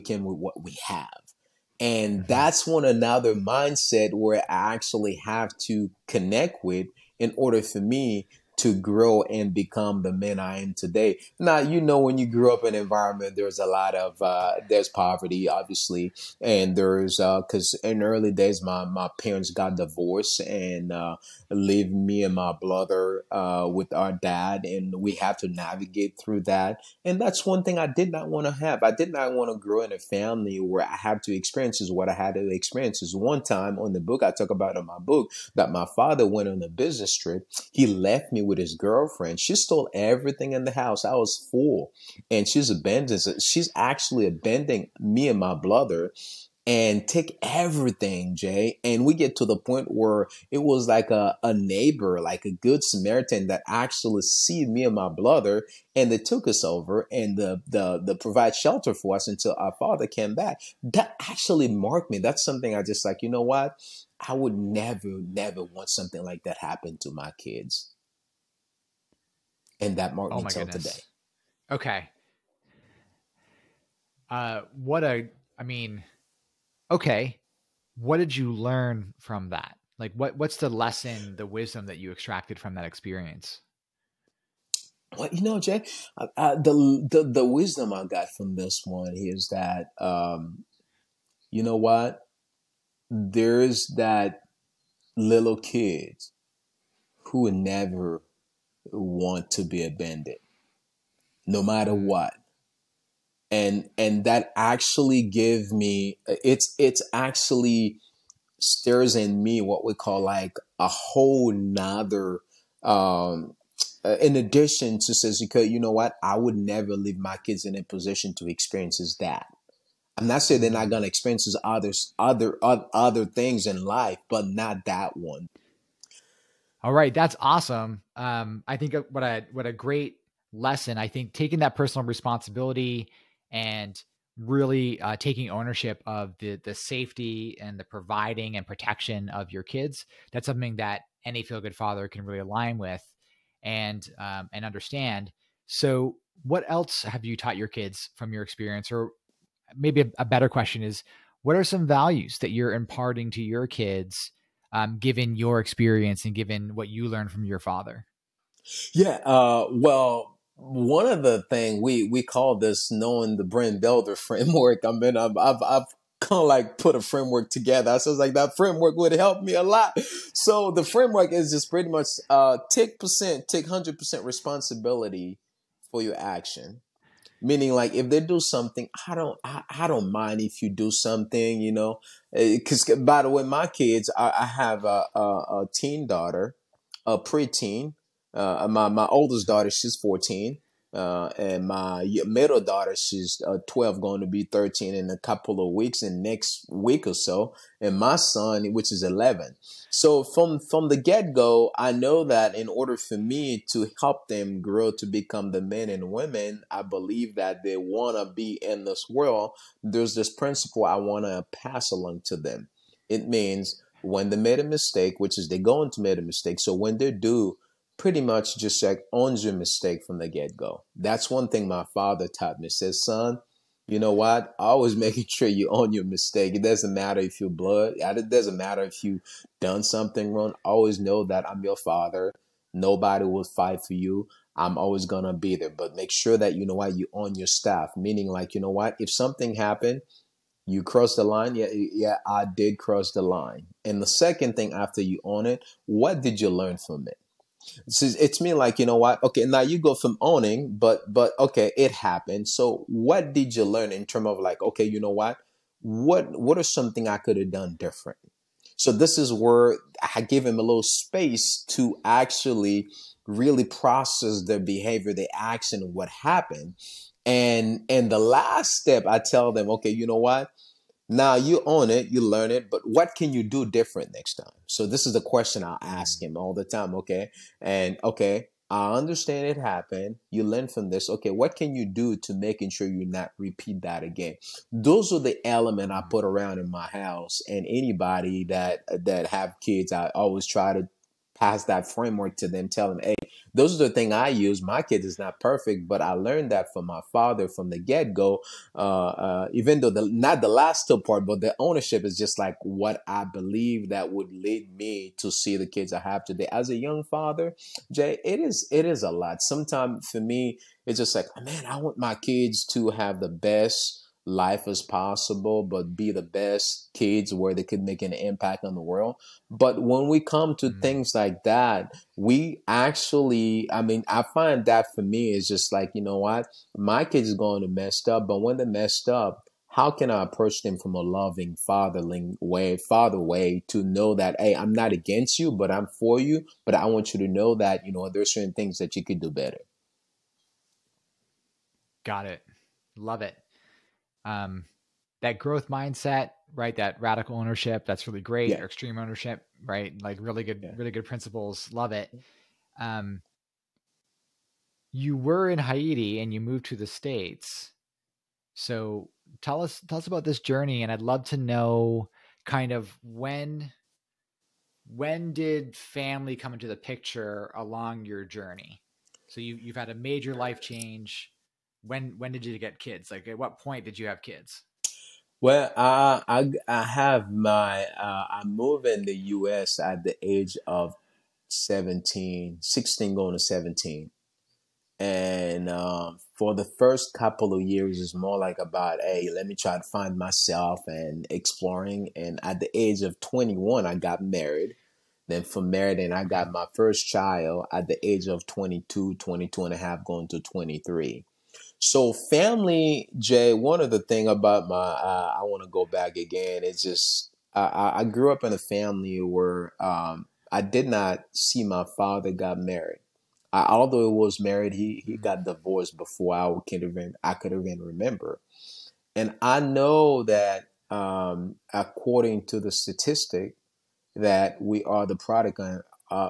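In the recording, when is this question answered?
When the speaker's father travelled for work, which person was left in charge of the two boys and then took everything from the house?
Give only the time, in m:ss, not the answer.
0:38.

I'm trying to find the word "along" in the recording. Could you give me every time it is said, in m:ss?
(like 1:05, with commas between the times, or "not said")
3:31, 6:07.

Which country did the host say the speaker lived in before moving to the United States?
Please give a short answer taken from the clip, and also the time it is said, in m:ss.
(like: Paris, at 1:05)
Haiti, at 5:55.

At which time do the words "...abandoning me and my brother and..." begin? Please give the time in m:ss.
0:44.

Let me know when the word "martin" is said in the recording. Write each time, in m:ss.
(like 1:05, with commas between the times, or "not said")
1:10.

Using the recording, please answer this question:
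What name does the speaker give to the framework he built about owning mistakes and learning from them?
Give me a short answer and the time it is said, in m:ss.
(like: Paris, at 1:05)
Brand Delta framework, at 2:43.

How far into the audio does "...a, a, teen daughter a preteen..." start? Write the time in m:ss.
3:05.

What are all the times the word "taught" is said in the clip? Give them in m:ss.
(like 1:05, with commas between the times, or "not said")
2:27, 3:42.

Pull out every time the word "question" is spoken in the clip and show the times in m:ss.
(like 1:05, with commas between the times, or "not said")
2:30, 4:35.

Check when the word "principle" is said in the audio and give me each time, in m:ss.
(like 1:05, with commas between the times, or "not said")
3:30, 5:51.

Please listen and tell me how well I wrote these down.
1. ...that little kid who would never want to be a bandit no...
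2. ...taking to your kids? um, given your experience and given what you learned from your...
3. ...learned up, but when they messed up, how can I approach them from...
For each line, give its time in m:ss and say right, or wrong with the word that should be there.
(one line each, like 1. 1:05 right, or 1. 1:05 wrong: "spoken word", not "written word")
1. 1:33 right
2. 2:32 wrong: "imparting", not "taking"
3. 5:27 wrong: "messed", not "learned".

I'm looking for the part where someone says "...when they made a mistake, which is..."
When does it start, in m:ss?
3:34.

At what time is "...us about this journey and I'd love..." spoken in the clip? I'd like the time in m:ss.
5:59.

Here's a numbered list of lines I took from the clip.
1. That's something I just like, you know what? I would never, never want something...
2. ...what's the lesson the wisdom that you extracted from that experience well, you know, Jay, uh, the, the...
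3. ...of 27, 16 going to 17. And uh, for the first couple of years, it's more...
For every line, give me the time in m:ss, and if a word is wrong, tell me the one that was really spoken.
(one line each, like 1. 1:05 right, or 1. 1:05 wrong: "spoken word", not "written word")
1. 1:02 right
2. 1:20 right
3. 6:20 wrong: "17", not "27".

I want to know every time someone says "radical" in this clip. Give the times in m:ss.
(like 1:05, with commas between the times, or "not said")
5:46.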